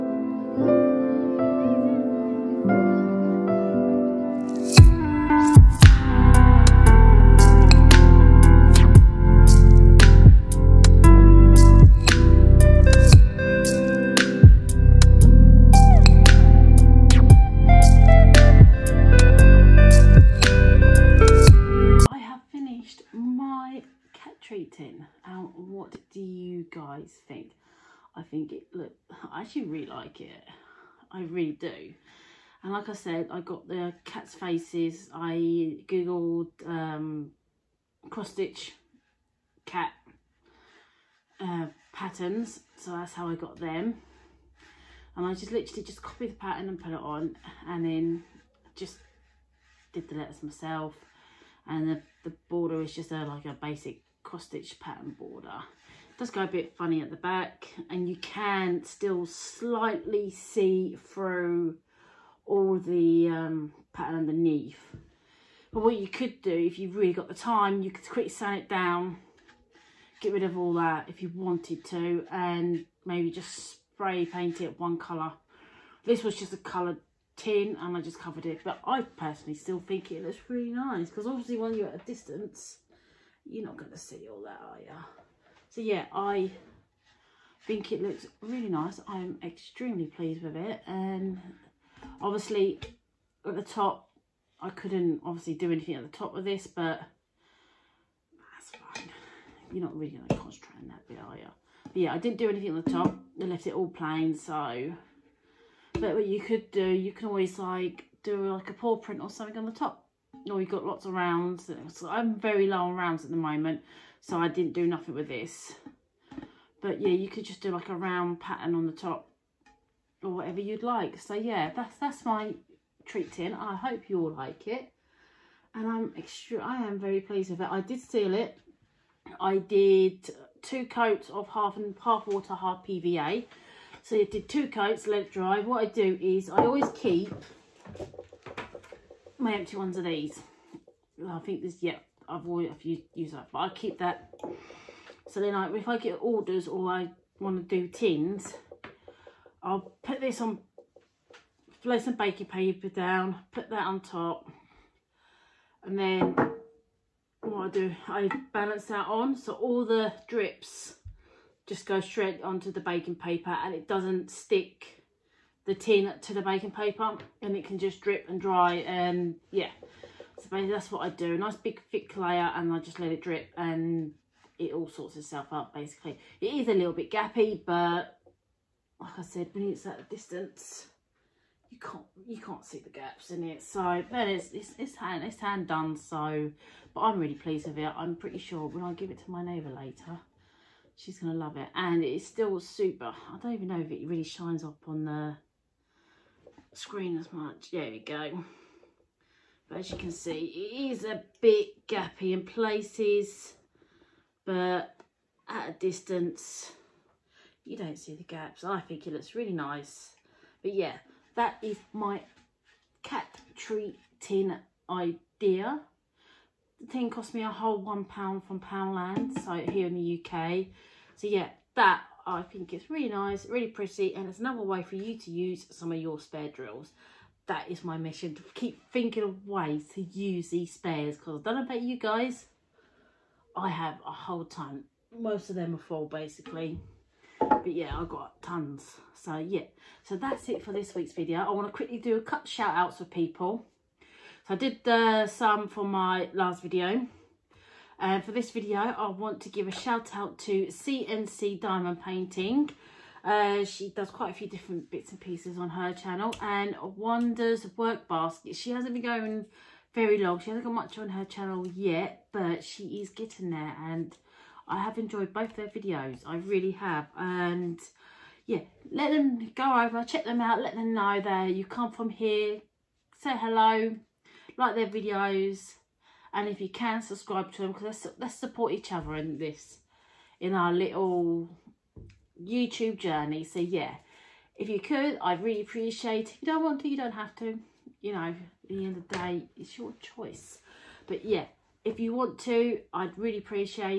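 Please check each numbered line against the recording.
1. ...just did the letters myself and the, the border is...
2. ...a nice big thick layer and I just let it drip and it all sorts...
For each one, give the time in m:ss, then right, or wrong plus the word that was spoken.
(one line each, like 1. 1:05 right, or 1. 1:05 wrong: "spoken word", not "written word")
1. 0:48 right
2. 2:51 right.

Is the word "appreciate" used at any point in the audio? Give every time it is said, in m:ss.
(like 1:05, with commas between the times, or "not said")
4:45, 4:53.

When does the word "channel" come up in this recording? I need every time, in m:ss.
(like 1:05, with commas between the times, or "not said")
4:15, 4:21.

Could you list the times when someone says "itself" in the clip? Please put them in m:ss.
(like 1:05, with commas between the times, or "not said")
2:55.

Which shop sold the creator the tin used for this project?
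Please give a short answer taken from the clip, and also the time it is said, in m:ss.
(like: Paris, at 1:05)
Poundland, at 3:38.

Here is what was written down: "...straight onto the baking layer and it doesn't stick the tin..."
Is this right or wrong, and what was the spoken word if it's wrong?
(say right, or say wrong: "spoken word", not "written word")
wrong: "paper", not "layer".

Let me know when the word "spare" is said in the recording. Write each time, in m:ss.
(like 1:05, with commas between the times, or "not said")
3:46, 3:50.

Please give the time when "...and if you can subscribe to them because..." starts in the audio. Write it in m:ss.
4:36.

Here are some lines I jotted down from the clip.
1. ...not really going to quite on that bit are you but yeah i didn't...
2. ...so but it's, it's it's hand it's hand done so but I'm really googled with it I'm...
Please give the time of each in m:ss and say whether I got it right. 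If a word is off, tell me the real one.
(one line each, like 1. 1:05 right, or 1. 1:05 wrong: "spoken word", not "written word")
1. 1:39 wrong: "concentrate", not "quite"
2. 3:03 wrong: "pleased", not "googled".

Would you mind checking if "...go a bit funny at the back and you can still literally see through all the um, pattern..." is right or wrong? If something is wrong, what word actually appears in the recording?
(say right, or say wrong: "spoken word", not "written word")
wrong: "slightly", not "literally".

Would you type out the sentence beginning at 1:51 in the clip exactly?
So I'm very low on rounds at the moment, so I didn't do nothing with this.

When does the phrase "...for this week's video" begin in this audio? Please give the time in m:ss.
4:00.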